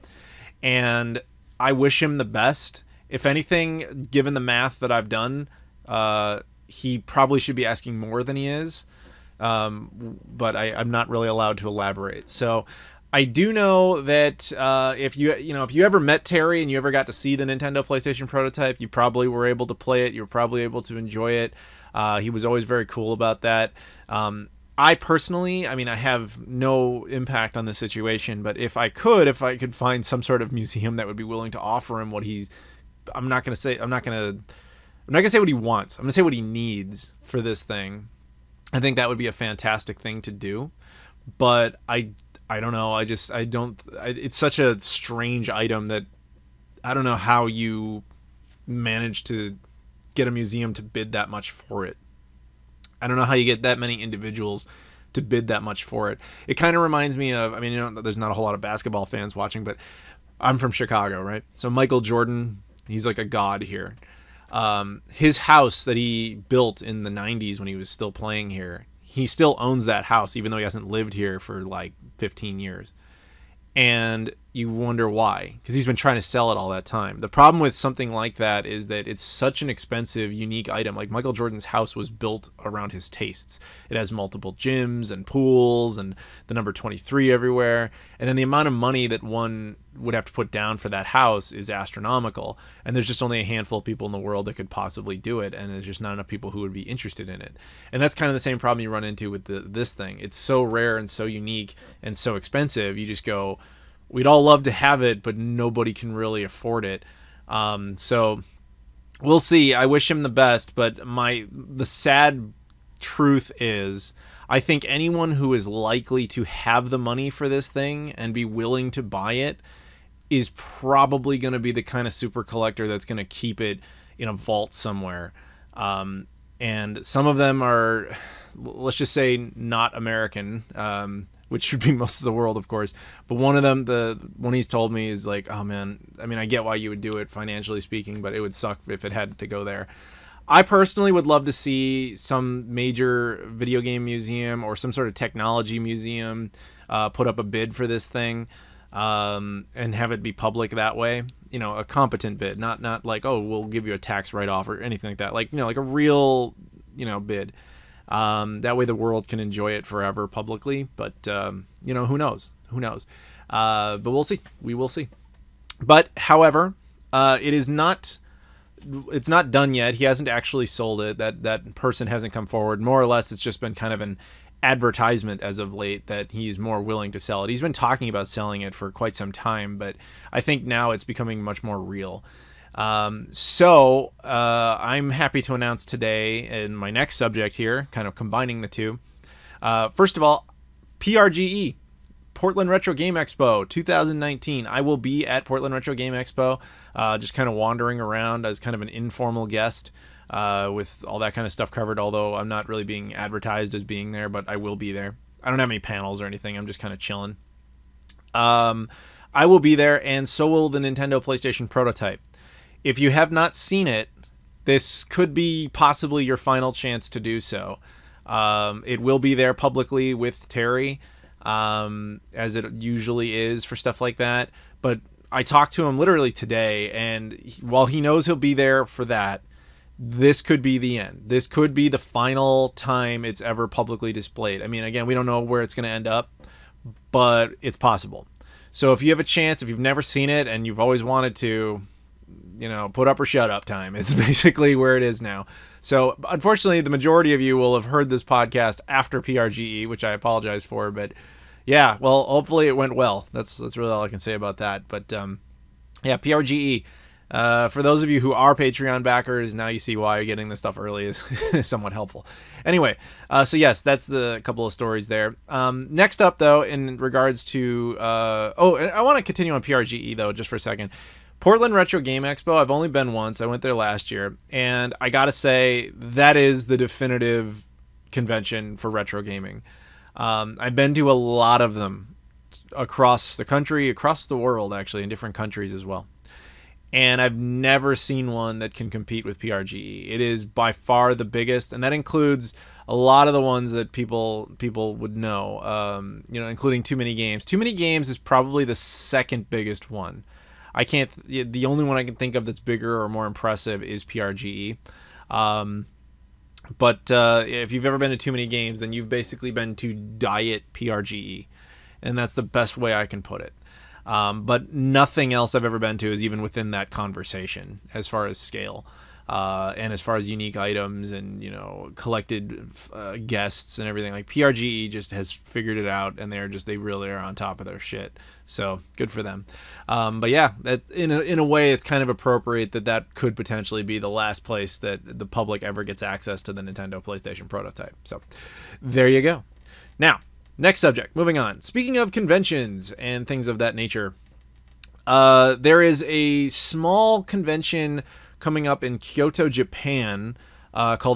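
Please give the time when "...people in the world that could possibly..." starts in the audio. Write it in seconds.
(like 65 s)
93 s.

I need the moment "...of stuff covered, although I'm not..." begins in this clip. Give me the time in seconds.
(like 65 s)
201 s.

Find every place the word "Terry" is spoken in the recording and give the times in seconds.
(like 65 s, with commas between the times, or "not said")
16 s, 220 s.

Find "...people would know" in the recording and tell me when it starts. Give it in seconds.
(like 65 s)
294 s.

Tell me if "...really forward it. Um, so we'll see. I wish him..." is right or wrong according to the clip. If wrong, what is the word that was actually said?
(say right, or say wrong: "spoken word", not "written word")
wrong: "afford", not "forward".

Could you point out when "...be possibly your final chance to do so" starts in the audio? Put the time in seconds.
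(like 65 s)
215 s.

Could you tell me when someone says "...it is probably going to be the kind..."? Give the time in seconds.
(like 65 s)
119 s.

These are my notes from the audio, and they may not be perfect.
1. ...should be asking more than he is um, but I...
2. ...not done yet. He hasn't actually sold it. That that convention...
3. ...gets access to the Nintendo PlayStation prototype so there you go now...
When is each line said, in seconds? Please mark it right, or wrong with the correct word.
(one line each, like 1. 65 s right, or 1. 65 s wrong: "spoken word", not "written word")
1. 7 s right
2. 169 s wrong: "person", not "convention"
3. 335 s right.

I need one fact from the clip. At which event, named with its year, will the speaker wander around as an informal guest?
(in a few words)
Portland Retro Game Expo 2019.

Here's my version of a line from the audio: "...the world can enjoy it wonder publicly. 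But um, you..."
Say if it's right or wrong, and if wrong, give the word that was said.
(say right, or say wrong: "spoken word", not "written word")
wrong: "forever", not "wonder".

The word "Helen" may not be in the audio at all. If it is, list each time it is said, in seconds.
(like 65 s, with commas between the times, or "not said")
not said.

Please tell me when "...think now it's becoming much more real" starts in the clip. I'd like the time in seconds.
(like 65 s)
180 s.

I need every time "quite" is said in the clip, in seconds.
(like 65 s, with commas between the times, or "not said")
178 s.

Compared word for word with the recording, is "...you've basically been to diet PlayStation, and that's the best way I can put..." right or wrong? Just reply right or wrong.
wrong.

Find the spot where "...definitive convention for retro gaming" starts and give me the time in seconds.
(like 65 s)
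276 s.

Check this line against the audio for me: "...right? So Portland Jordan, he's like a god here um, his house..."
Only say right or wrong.
wrong.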